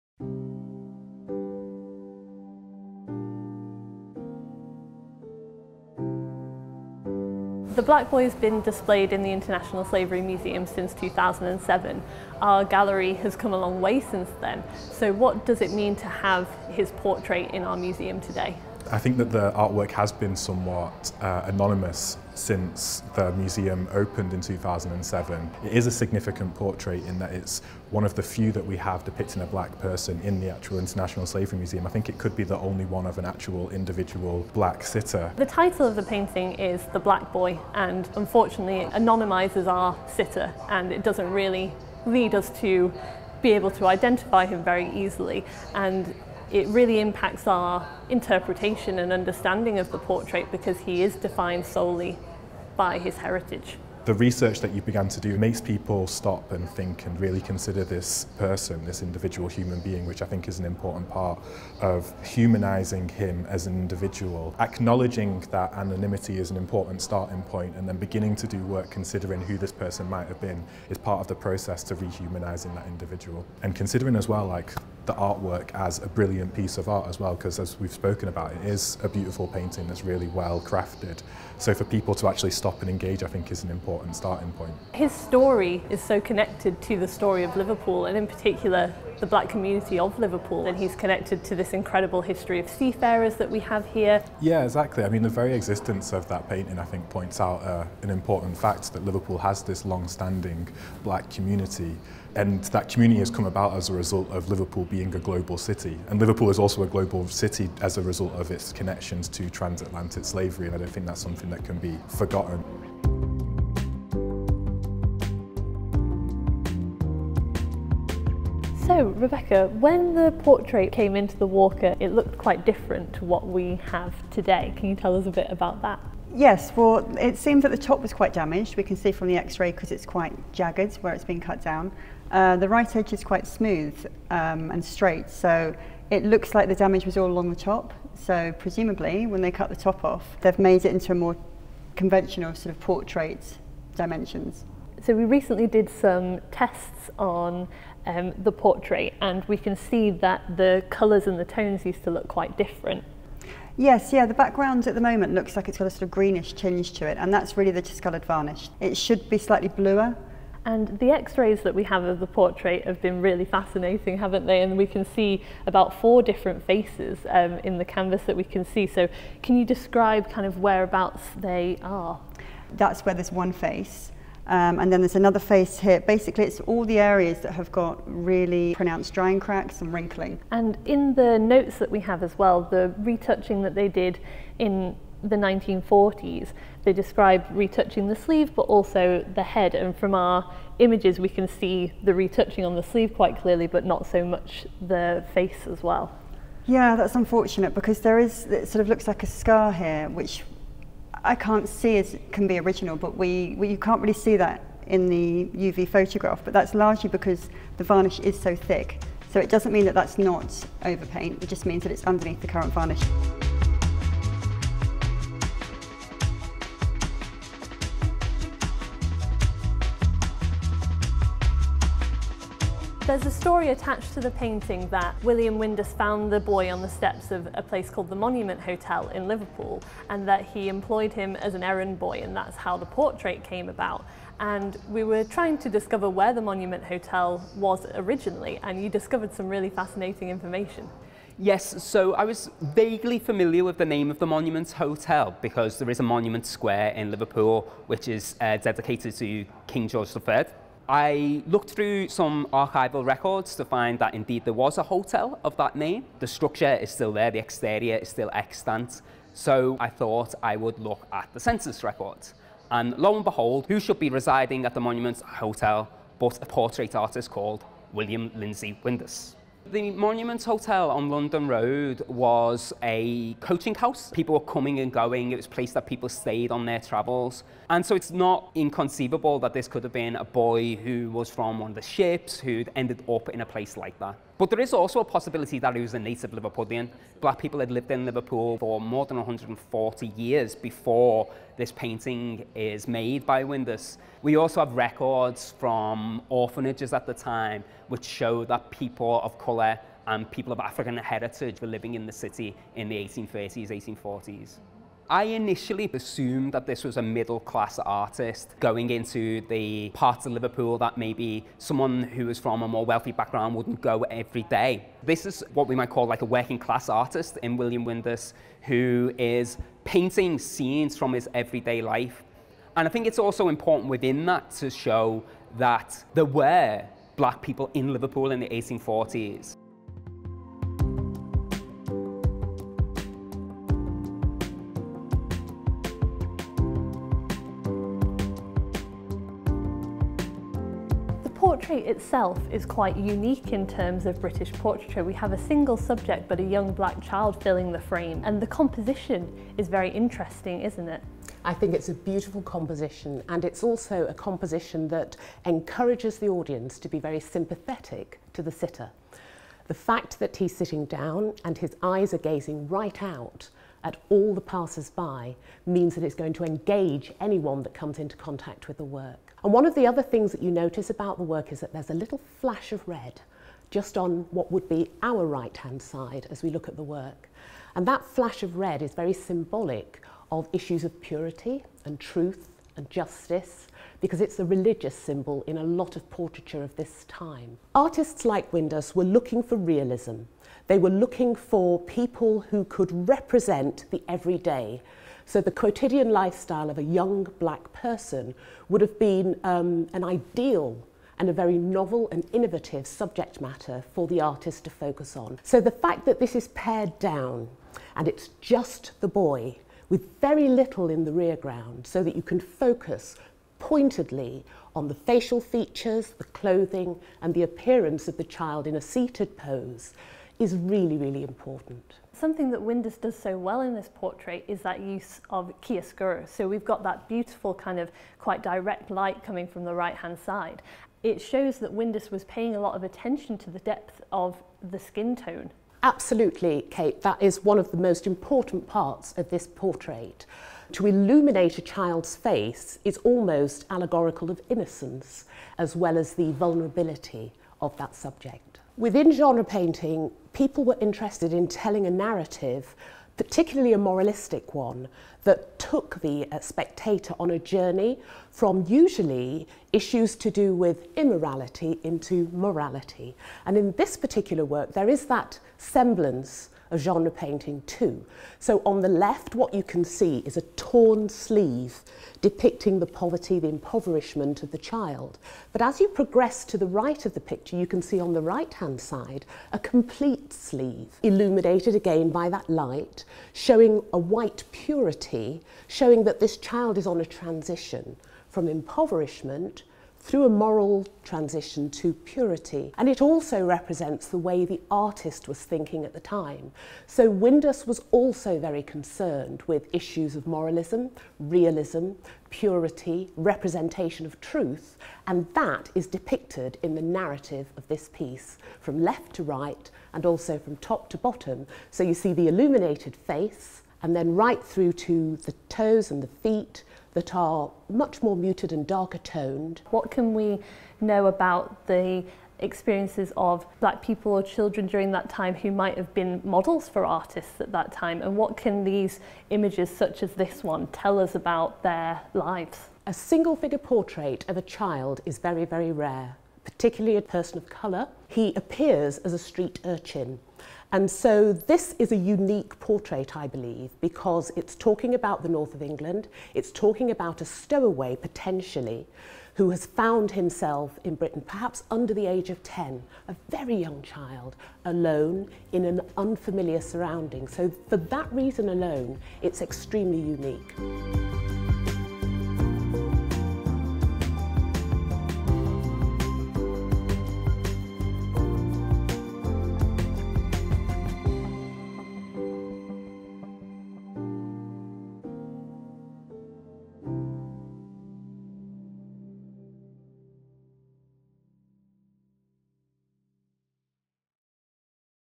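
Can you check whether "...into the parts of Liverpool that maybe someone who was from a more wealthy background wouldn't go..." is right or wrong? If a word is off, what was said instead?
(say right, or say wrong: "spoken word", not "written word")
right.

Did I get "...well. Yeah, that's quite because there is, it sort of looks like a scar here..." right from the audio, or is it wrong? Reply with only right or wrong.
wrong.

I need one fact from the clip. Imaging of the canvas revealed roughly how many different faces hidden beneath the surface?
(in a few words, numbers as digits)
4.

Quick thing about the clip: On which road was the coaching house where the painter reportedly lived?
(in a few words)
London Road.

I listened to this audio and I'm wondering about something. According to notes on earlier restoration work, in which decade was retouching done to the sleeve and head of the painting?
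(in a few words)
1940s.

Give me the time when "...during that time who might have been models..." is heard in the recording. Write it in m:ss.
8:44.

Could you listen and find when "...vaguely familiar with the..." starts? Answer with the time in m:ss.
4:02.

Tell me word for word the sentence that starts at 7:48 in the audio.
So on the left, what you can see is a torn sleeve depicting the poverty, the impoverishment of the child.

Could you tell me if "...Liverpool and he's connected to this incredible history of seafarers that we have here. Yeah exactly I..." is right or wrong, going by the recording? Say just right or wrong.
right.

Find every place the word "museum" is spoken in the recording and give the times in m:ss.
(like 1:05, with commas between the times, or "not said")
0:10, 0:17, 0:23, 0:31.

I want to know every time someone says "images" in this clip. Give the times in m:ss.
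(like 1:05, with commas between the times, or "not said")
3:10, 8:49.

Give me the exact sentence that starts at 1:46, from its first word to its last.
And Liverpool is also a global city as a result of its connections to transatlantic slavery.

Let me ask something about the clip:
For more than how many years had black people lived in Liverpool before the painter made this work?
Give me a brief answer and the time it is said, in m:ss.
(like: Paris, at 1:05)
140, at 4:49.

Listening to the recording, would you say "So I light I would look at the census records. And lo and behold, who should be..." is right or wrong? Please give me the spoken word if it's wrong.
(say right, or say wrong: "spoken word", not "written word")
wrong: "thought", not "light".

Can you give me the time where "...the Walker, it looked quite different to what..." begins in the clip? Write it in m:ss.
2:01.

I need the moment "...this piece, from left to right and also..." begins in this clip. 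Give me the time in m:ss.
8:27.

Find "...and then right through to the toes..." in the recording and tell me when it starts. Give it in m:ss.
8:33.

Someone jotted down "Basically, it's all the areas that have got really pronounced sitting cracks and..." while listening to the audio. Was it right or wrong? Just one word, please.
wrong.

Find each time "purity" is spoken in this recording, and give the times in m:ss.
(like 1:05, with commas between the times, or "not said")
6:21, 8:04, 8:11, 8:22.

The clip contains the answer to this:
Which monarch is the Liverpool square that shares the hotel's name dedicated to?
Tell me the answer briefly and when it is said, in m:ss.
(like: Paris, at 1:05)
King George III, at 4:09.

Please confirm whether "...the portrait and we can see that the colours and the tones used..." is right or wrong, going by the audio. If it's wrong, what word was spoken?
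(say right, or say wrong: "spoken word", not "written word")
right.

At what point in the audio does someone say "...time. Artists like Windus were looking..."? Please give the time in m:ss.
6:27.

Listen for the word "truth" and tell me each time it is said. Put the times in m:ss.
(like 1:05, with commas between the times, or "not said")
6:21, 8:24.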